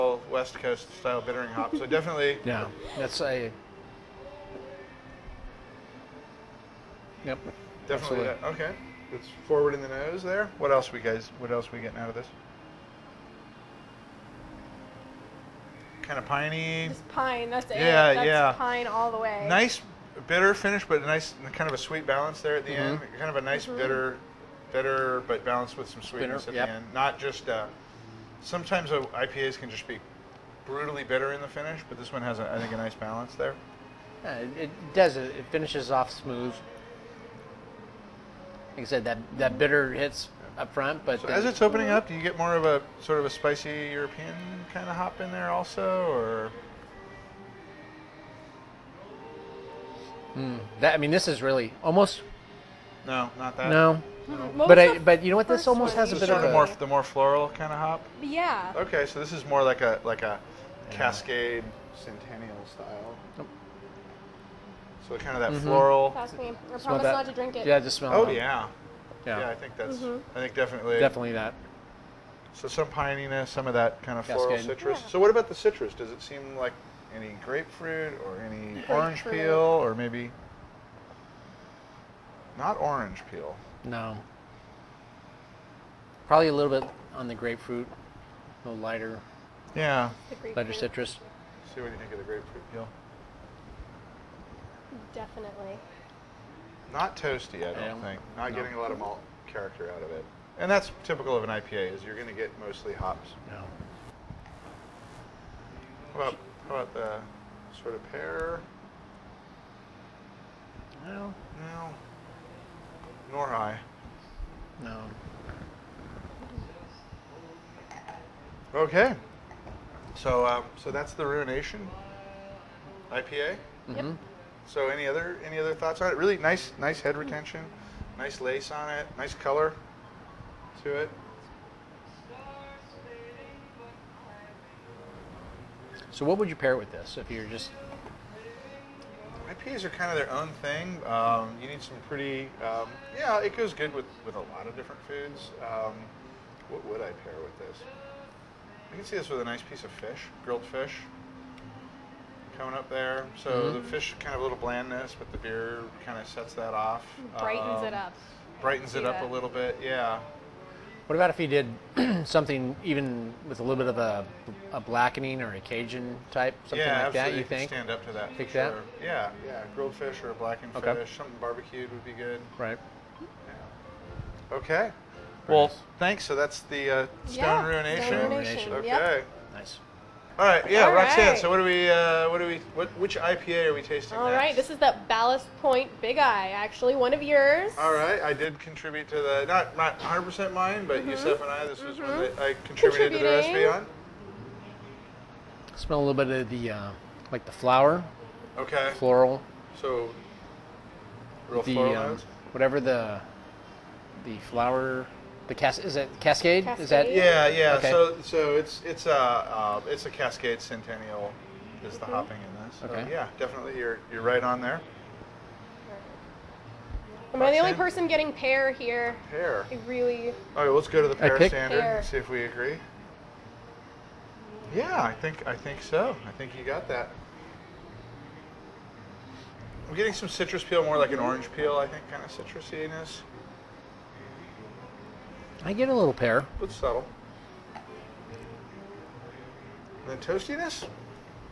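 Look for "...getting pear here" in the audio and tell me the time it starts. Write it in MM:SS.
03:38.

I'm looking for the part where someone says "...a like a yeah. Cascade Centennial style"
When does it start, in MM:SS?
00:59.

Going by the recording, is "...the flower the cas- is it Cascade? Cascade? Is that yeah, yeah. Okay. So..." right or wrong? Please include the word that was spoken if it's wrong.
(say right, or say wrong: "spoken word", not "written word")
right.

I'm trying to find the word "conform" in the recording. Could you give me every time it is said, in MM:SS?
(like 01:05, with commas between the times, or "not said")
not said.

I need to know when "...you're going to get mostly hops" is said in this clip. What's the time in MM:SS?
01:42.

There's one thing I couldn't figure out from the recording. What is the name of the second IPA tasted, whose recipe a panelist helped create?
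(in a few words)
Ballast Point Big Eye.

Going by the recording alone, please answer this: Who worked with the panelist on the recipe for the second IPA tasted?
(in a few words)
Yusef.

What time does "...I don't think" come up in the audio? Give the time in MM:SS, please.
01:37.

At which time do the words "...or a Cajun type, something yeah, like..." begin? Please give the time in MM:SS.
02:45.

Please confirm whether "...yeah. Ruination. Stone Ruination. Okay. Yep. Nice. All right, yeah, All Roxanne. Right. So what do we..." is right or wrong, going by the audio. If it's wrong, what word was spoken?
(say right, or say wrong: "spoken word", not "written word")
right.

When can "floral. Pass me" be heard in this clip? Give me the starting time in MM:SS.
01:05.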